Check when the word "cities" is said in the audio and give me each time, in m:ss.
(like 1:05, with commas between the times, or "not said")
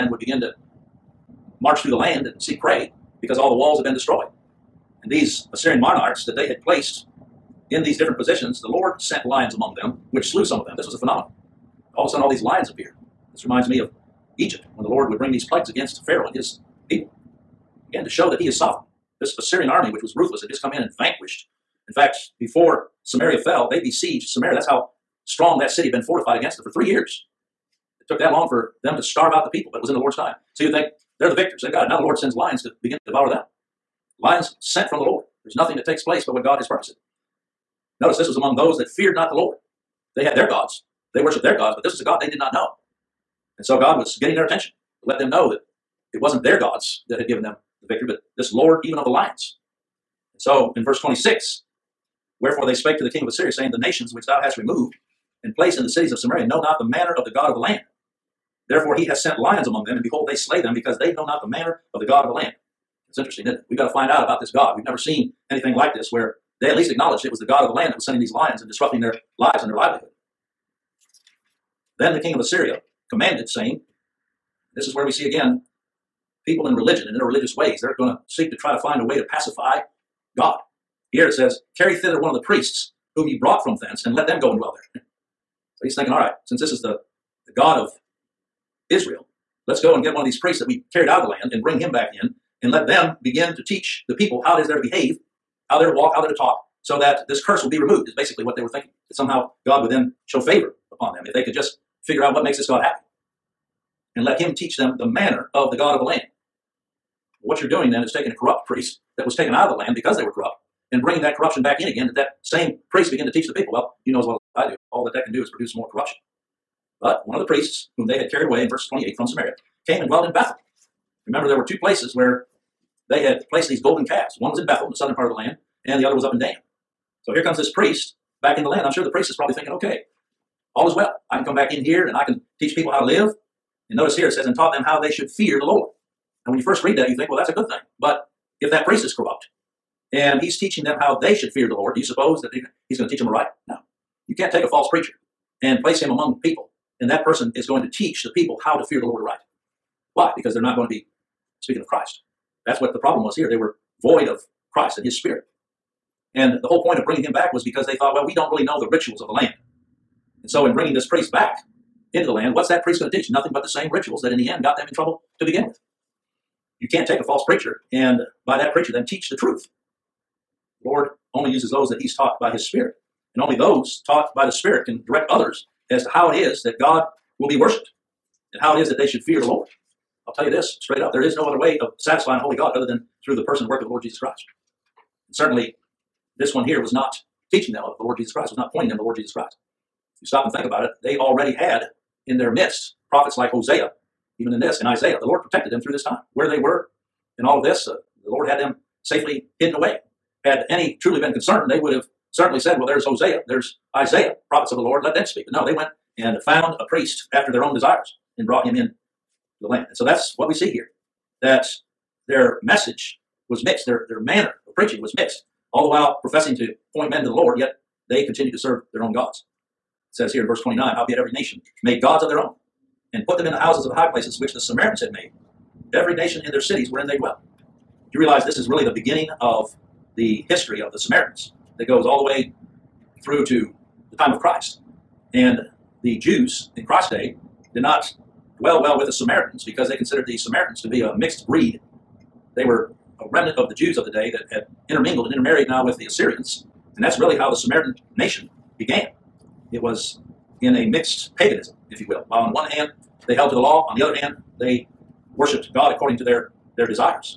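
0:55, 3:46.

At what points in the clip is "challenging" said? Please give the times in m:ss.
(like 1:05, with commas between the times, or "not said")
not said.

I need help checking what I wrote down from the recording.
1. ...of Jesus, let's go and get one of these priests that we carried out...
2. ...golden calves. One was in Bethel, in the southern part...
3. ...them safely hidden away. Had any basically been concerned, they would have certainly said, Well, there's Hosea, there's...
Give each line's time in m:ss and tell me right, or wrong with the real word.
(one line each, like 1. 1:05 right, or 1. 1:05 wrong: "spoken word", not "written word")
1. 1:27 wrong: "Israel", not "Jesus"
2. 2:03 right
3. 3:18 wrong: "truly", not "basically".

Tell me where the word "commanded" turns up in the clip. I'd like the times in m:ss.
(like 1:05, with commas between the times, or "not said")
1:13.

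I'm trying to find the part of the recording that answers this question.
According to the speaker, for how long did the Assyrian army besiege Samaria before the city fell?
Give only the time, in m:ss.
0:26.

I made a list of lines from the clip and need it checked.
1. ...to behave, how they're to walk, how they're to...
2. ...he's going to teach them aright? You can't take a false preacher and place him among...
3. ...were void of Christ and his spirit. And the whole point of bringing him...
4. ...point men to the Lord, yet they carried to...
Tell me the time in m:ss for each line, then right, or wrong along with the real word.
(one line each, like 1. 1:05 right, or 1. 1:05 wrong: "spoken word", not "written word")
1. 1:34 right
2. 2:22 right
3. 2:33 right
4. 3:36 wrong: "continued", not "carried".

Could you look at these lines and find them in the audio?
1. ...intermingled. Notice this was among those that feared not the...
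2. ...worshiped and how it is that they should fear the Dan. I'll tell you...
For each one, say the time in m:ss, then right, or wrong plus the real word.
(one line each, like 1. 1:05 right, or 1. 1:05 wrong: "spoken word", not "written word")
1. 0:36 wrong: "purposed", not "intermingled"
2. 2:57 wrong: "Lord", not "Dan".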